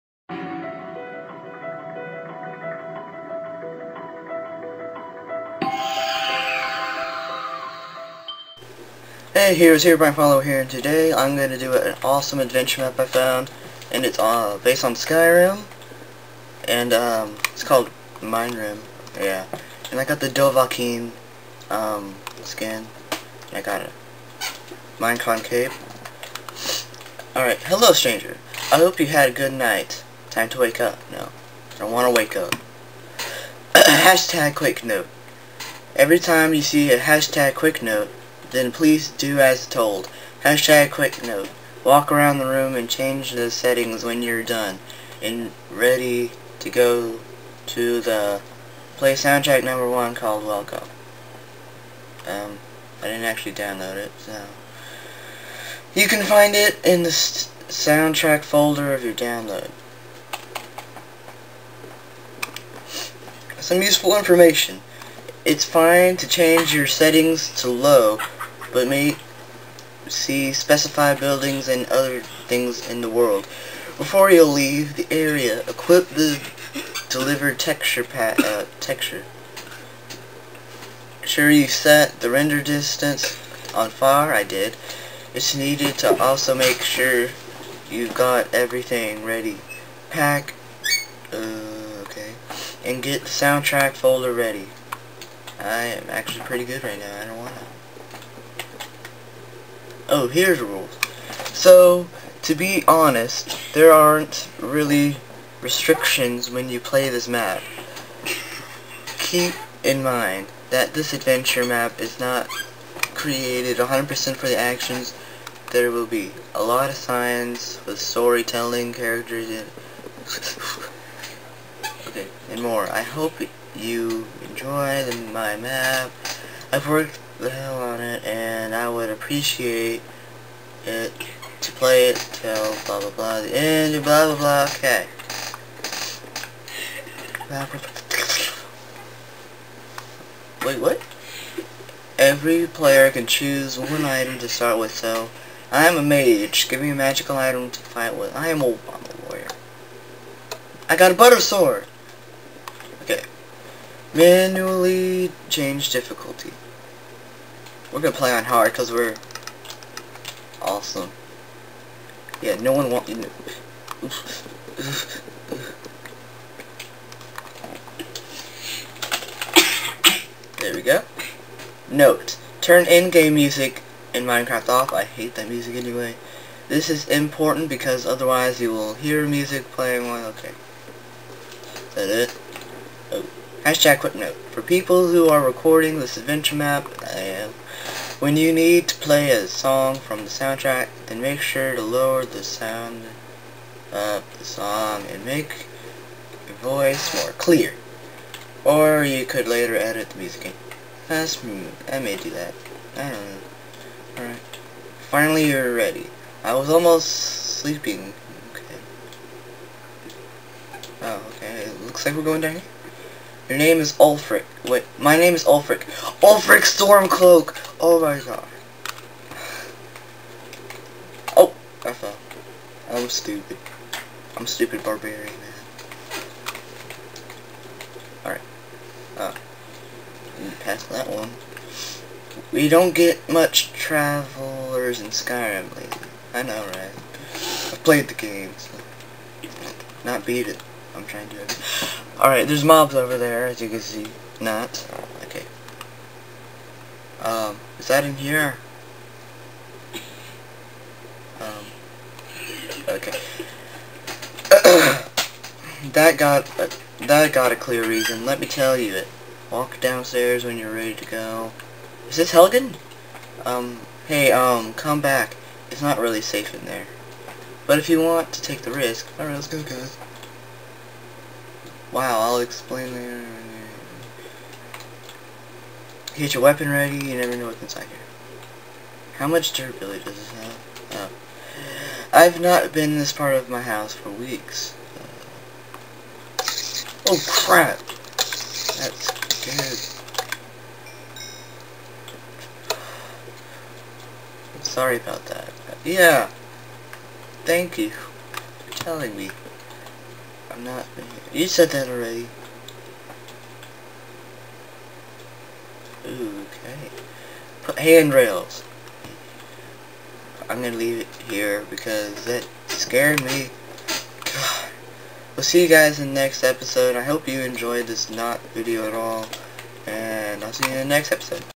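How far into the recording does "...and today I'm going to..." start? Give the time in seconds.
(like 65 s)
10 s.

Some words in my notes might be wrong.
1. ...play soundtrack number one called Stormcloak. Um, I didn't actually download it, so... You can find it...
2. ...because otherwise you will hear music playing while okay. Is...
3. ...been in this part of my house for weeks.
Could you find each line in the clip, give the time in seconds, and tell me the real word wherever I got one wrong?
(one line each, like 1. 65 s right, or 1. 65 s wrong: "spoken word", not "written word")
1. 48 s wrong: "Welcome", not "Stormcloak"
2. 177 s right
3. 282 s right.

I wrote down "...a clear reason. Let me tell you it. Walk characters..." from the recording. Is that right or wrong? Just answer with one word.
wrong.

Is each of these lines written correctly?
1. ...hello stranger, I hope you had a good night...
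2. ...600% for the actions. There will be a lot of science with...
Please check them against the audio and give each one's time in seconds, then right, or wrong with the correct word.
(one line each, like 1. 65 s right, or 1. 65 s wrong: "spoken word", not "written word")
1. 27 s right
2. 113 s wrong: "100", not "600".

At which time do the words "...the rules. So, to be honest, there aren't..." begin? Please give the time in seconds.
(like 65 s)
100 s.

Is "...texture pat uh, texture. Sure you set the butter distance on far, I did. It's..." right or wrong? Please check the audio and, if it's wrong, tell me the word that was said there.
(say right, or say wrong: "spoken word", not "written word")
wrong: "render", not "butter".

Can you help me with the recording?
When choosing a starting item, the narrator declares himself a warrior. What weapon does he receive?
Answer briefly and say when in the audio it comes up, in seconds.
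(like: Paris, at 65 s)
butter sword, at 151 s.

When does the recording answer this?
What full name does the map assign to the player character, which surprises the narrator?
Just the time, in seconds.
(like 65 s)
216 s.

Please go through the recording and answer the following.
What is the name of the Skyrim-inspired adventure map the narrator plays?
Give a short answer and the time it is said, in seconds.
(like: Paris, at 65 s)
Mine Rim, at 18 s.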